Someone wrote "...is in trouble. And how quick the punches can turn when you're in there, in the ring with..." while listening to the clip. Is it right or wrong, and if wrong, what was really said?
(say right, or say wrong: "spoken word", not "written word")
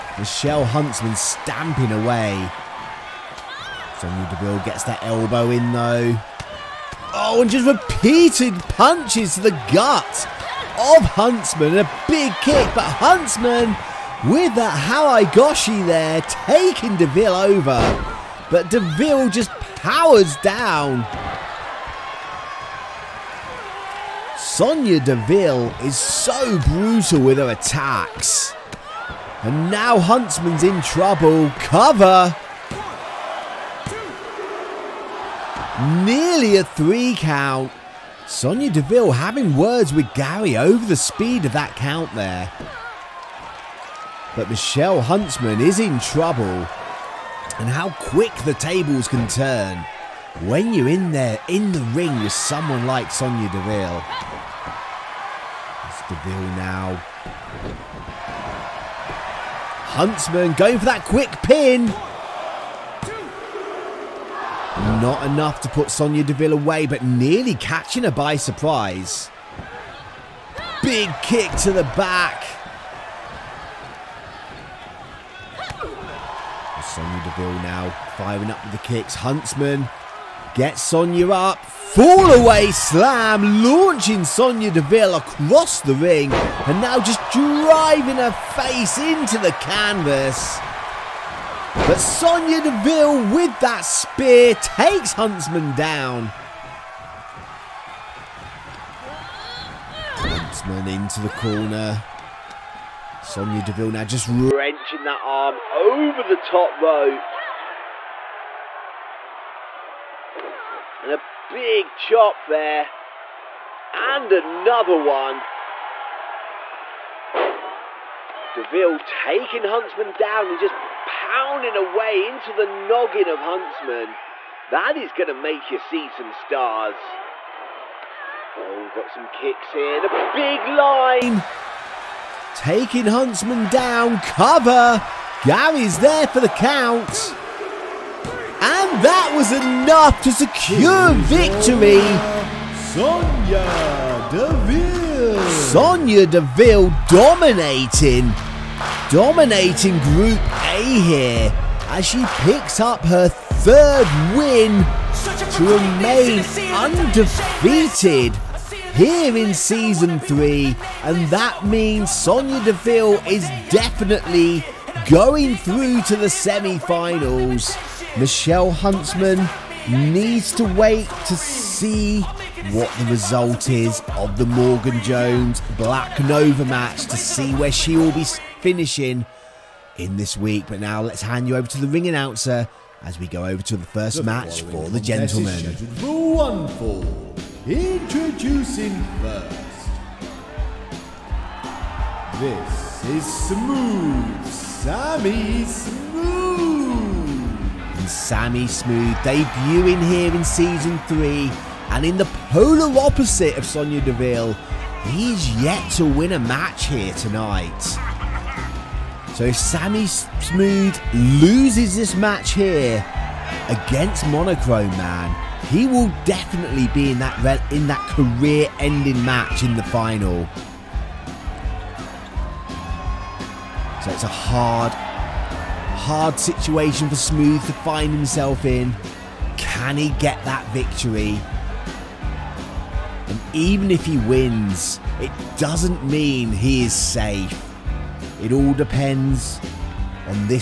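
wrong: "tables", not "punches".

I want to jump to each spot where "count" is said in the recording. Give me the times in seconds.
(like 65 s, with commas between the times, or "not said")
37 s, 41 s, 136 s.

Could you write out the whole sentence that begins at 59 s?
Huntsman going for that quick pin.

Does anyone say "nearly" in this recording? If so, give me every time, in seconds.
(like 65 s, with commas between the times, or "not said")
35 s, 67 s.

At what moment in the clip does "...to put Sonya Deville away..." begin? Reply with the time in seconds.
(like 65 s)
65 s.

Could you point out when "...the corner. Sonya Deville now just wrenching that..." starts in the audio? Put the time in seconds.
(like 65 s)
101 s.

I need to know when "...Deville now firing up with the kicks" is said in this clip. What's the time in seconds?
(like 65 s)
77 s.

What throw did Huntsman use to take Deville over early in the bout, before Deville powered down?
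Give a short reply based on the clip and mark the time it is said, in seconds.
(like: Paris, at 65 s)
Hawagoshi, at 14 s.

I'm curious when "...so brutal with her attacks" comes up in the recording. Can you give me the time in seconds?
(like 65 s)
25 s.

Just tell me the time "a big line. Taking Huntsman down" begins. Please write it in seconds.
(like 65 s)
129 s.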